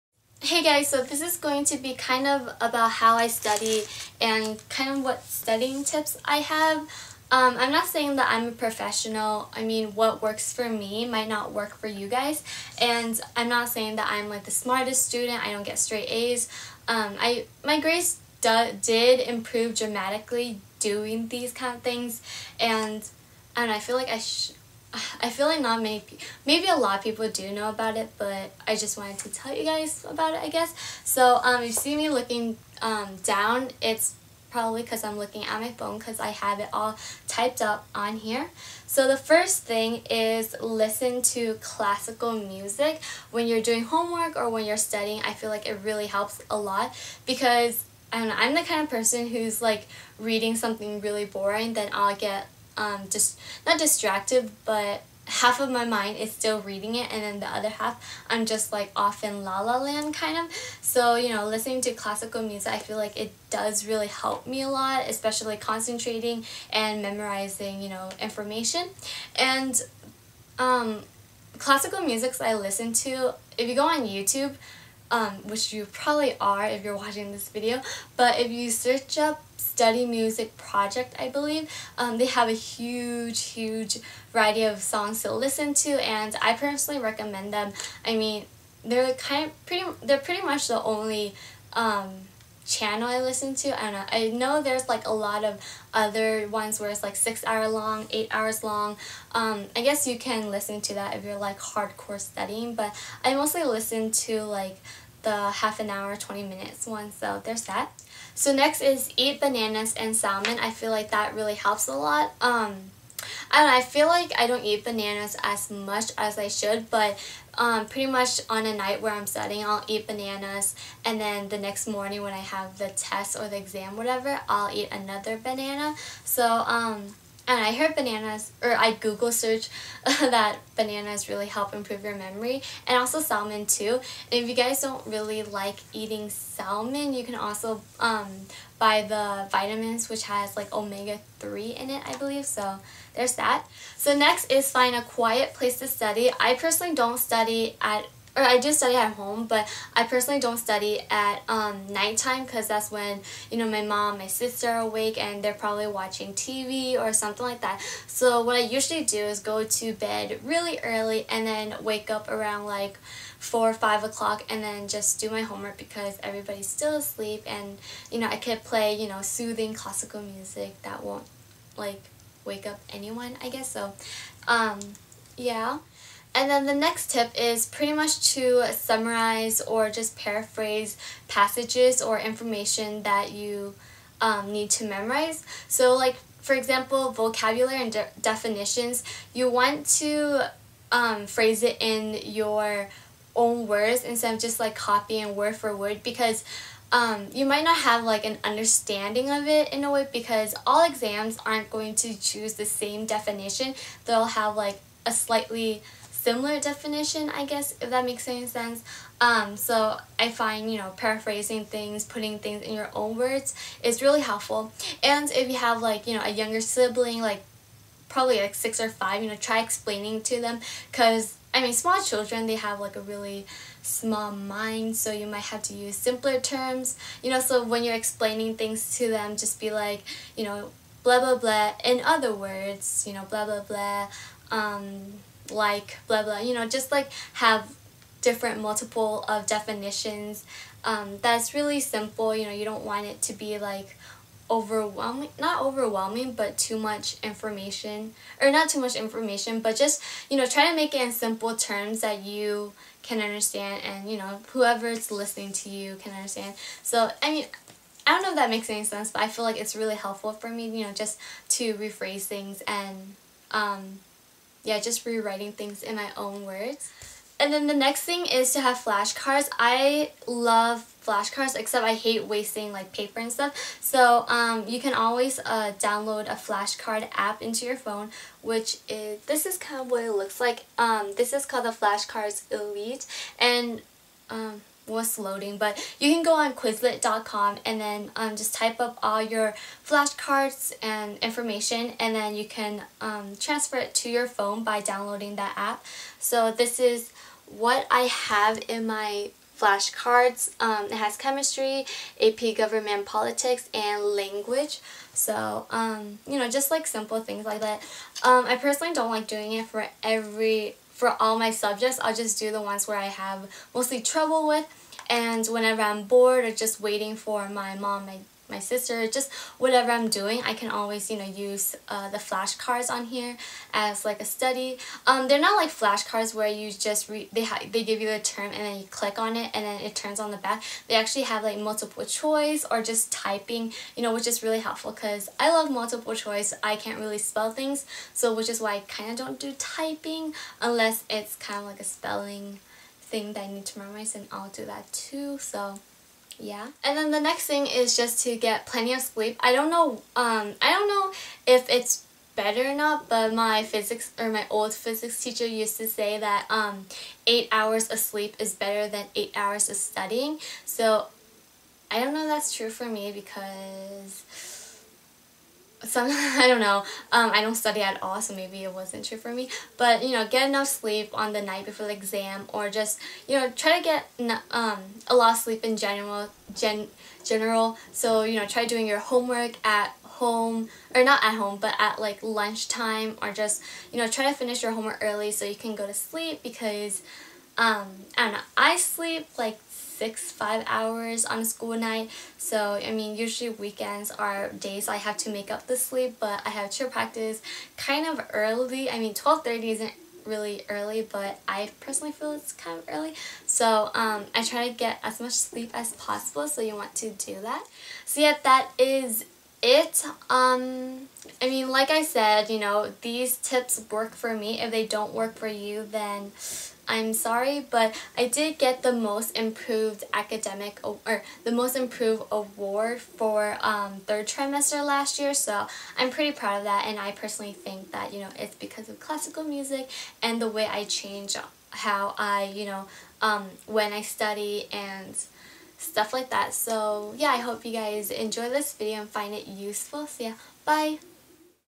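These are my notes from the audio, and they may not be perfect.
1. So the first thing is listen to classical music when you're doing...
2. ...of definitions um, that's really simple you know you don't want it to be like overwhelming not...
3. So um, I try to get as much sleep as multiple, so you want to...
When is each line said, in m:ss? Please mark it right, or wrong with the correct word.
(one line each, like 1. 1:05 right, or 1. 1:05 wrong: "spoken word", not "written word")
1. 0:38 right
2. 3:59 right
3. 6:43 wrong: "possible", not "multiple".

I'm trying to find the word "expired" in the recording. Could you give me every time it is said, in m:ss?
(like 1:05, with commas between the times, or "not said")
not said.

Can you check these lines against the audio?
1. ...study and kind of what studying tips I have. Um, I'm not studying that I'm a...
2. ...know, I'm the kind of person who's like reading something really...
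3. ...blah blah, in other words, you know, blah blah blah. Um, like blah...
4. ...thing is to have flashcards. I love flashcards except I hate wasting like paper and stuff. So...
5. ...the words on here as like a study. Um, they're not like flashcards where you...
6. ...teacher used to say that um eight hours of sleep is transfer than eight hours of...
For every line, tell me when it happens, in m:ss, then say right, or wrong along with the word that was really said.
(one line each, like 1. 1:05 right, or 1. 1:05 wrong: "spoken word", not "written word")
1. 0:03 wrong: "saying", not "studying"
2. 0:48 right
3. 3:51 right
4. 4:28 right
5. 5:22 wrong: "flashcards", not "words"
6. 5:55 wrong: "better", not "transfer".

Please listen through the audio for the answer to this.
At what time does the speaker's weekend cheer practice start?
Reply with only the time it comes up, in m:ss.
6:39.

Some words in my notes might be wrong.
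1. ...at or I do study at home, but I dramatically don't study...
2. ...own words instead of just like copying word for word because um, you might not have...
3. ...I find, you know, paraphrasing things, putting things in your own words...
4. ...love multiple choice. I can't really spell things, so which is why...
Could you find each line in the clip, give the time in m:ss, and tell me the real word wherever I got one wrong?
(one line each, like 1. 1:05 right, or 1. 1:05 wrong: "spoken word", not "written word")
1. 2:27 wrong: "personally", not "dramatically"
2. 3:13 right
3. 3:30 right
4. 5:35 right.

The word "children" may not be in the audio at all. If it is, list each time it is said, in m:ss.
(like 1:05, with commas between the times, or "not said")
3:42.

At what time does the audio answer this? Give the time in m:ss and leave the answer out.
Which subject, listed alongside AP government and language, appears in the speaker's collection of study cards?
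5:01.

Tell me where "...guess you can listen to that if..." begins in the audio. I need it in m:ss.
1:39.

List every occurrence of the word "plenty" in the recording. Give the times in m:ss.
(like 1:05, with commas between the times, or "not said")
5:48.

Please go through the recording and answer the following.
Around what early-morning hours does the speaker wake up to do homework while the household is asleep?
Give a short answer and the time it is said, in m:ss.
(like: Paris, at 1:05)
4 or 5 o'clock, at 2:43.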